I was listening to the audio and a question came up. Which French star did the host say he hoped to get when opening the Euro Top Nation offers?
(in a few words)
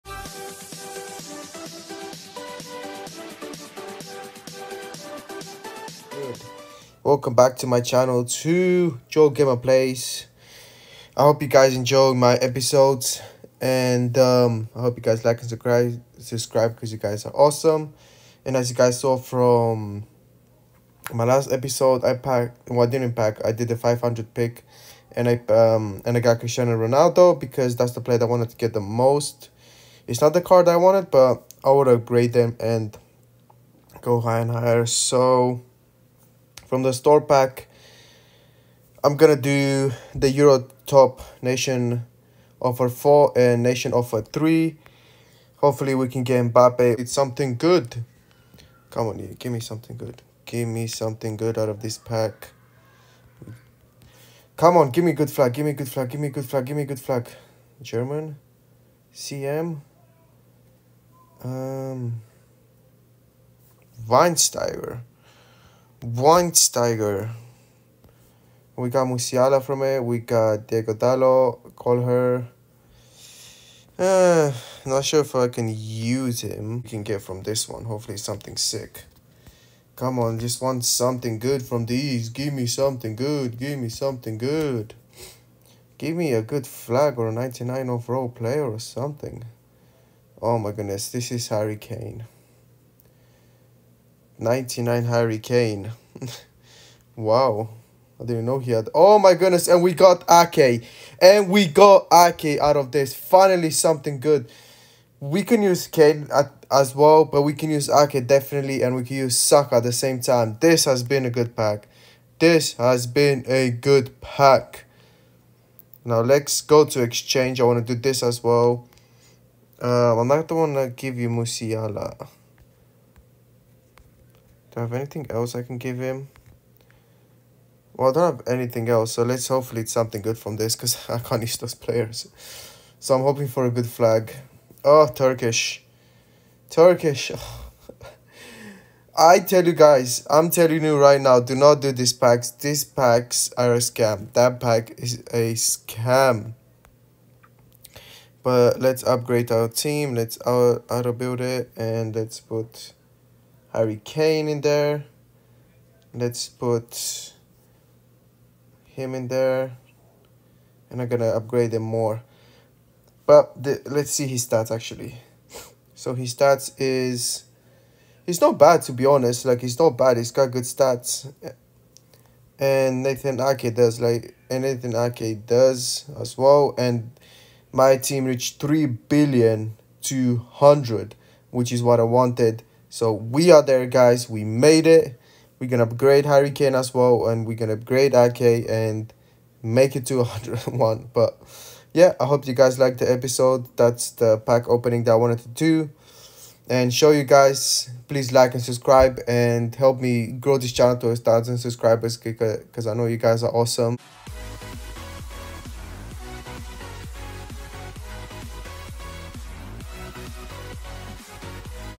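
Mbappe.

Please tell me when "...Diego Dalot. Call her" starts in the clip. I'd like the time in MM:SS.
01:10.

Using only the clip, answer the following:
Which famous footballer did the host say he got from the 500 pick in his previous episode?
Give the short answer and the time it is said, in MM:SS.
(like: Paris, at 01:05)
Cristiano Ronaldo, at 00:26.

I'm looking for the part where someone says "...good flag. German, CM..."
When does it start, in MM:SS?
00:56.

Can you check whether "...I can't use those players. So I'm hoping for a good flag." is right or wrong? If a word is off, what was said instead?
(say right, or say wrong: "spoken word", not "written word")
right.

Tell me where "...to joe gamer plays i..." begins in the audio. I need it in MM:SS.
00:08.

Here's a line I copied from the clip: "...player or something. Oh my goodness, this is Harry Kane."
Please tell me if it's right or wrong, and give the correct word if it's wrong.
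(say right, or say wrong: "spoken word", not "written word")
right.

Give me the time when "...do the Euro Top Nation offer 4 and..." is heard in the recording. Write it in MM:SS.
00:39.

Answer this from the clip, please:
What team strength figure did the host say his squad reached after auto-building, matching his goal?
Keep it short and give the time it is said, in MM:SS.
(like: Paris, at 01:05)
3 billion 200, at 02:58.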